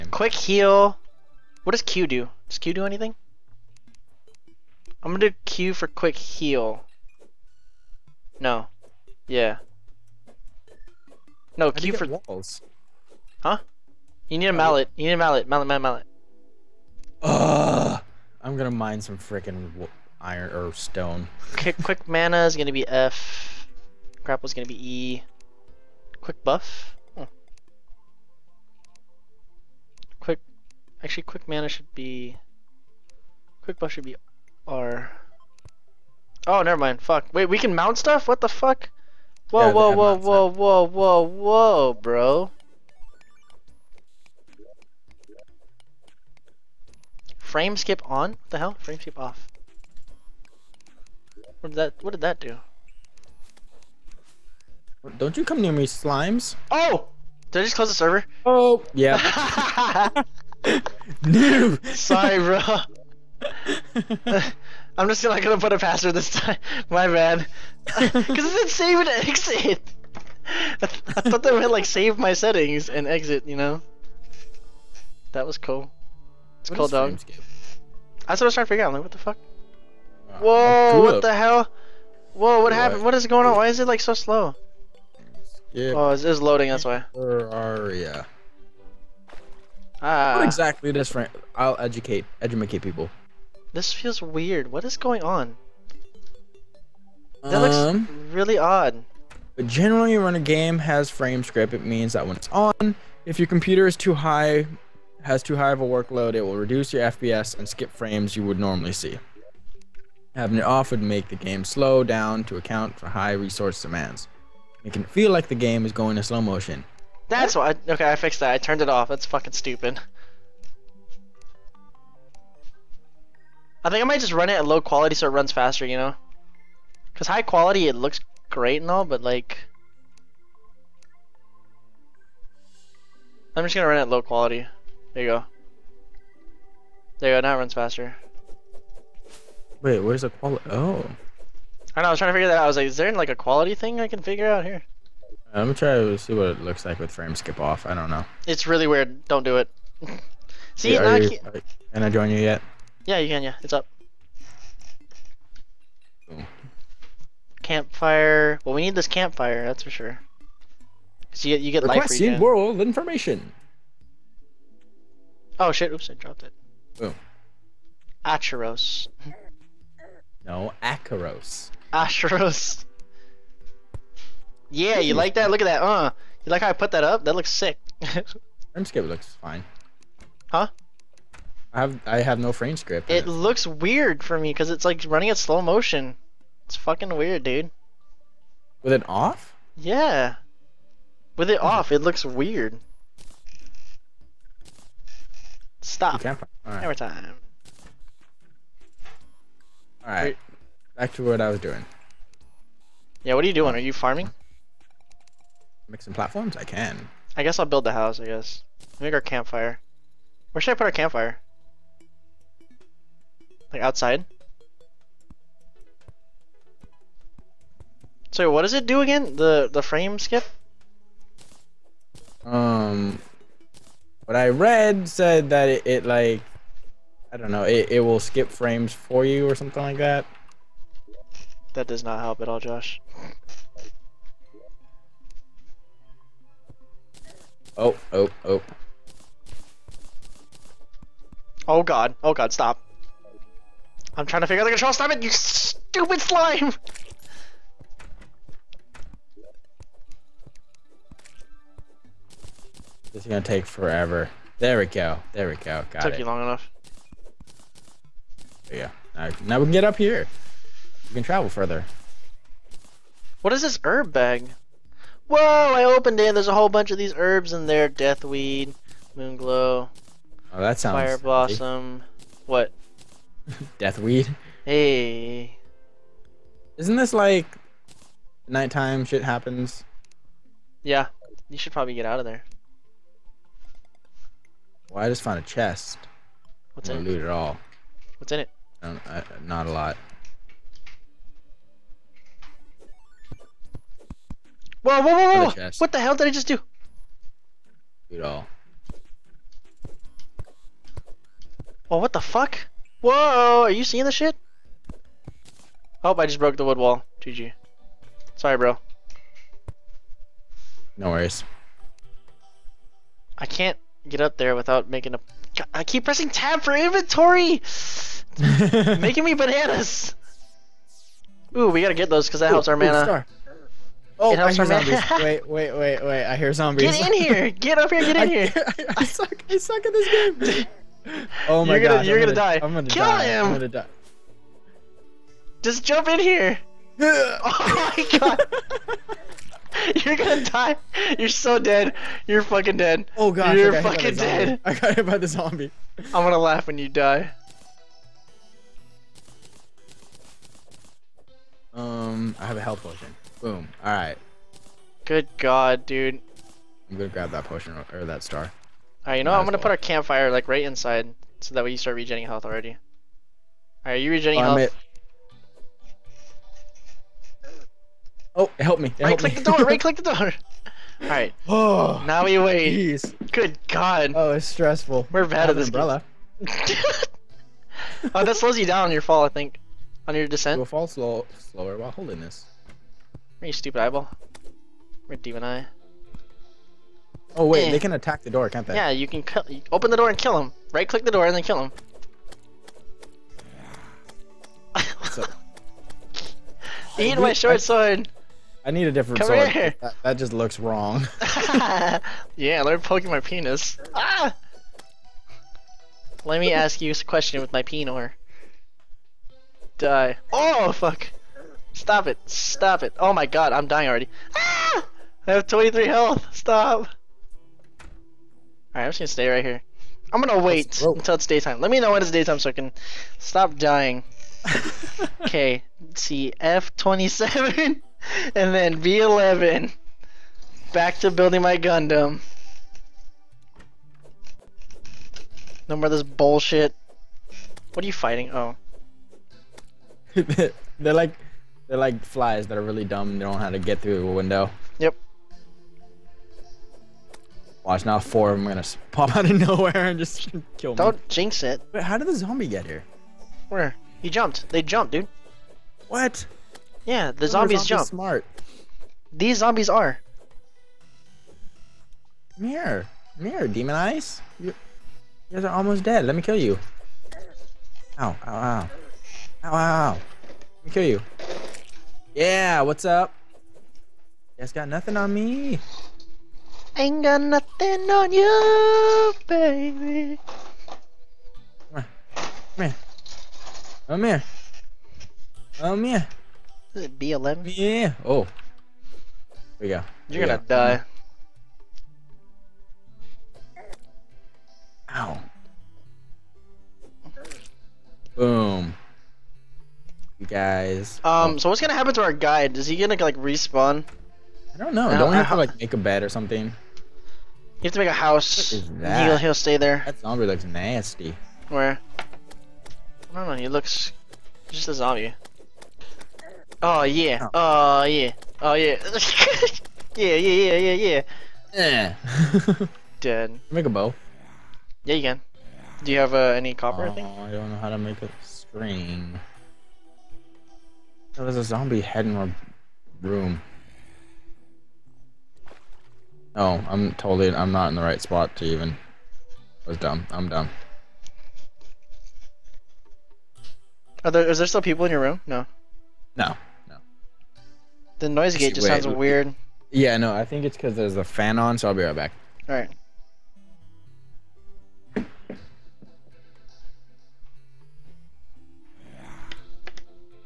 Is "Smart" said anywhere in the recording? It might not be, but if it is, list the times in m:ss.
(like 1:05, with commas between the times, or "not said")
7:37.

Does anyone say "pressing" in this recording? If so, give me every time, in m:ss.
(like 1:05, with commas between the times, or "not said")
5:16.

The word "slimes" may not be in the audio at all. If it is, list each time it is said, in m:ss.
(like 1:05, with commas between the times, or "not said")
0:55, 4:06.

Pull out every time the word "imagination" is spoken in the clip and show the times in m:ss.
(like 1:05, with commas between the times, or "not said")
not said.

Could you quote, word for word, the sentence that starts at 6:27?
they can attack the door, can't they?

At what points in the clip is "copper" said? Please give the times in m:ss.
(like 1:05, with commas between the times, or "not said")
8:46.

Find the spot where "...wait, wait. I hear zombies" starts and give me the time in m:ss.
5:25.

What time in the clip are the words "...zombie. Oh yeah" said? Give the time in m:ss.
8:34.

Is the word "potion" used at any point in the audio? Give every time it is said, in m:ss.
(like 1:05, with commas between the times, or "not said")
5:52, 5:57.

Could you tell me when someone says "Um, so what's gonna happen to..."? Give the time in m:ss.
8:21.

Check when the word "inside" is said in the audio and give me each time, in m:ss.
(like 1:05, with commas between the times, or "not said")
6:00.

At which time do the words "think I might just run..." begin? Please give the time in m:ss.
2:03.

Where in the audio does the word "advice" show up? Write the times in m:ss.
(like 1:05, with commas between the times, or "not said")
not said.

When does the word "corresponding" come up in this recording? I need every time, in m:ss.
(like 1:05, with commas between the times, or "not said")
not said.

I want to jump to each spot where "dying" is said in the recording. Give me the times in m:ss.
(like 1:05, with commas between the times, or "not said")
6:53, 7:03.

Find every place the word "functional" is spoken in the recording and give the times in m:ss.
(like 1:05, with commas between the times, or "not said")
not said.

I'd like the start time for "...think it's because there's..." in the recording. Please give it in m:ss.
9:10.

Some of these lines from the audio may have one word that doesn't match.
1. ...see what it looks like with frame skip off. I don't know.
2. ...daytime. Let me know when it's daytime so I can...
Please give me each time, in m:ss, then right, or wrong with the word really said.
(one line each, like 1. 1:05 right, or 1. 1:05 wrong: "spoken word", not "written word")
1. 2:26 right
2. 7:01 right.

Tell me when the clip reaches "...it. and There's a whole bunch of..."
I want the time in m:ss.
4:26.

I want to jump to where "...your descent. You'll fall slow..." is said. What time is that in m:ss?
6:20.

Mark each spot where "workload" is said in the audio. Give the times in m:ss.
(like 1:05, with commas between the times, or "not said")
1:45.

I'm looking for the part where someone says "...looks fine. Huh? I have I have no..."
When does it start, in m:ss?
2:59.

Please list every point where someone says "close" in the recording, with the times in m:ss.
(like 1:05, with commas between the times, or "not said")
0:57.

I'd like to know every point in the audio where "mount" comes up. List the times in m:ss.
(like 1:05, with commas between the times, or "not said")
0:37.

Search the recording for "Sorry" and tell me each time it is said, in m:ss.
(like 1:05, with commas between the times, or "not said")
1:01, 5:08.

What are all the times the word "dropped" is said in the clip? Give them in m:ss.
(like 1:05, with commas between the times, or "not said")
2:46.